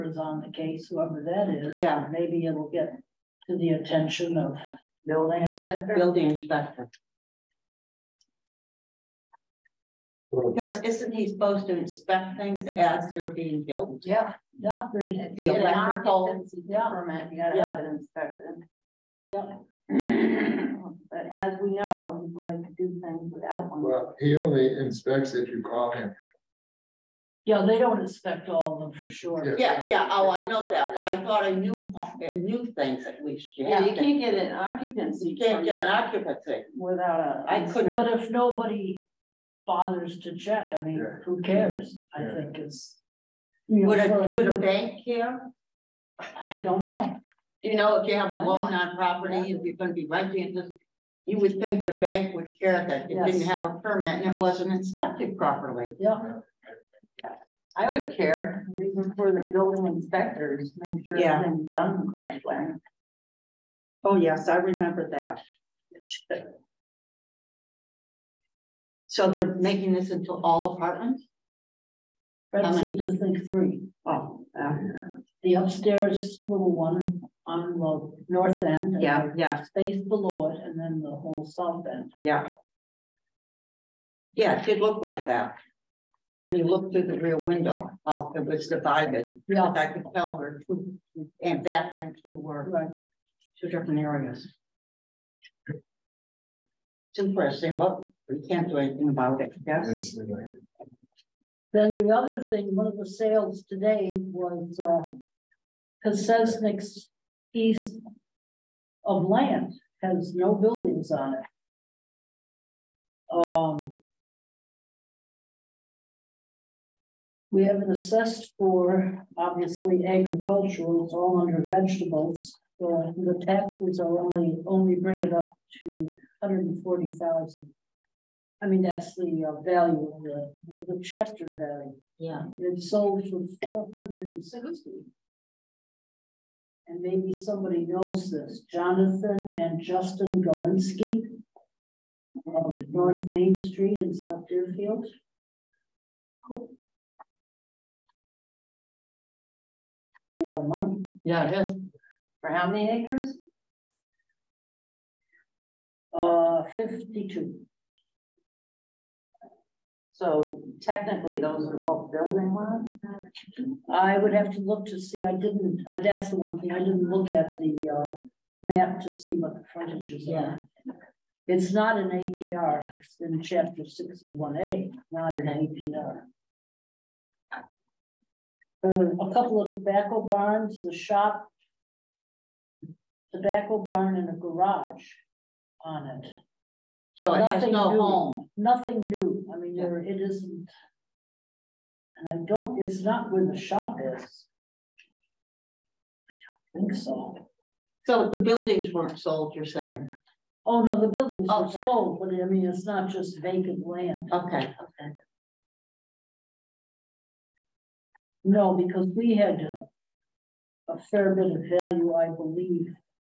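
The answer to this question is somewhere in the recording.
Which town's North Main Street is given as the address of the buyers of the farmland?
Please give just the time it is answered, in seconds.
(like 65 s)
144 s.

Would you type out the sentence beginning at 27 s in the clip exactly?
Yeah, they don't inspect all of them for sure.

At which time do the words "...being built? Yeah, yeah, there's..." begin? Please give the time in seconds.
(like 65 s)
13 s.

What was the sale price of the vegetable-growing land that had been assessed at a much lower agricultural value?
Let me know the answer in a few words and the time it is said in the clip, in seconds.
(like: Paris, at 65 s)
460, at 133 s.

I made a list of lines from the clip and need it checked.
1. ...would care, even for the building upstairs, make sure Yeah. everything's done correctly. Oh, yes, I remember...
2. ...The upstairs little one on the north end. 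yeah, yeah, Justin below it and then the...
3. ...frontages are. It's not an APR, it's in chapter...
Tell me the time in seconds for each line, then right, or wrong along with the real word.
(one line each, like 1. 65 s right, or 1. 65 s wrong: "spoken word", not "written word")
1. 57 s wrong: "inspectors", not "upstairs"
2. 75 s wrong: "Space", not "Justin"
3. 169 s right.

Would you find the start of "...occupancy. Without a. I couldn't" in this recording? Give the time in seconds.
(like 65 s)
35 s.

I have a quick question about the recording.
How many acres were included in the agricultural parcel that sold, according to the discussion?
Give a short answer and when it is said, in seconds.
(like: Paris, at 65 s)
52, at 156 s.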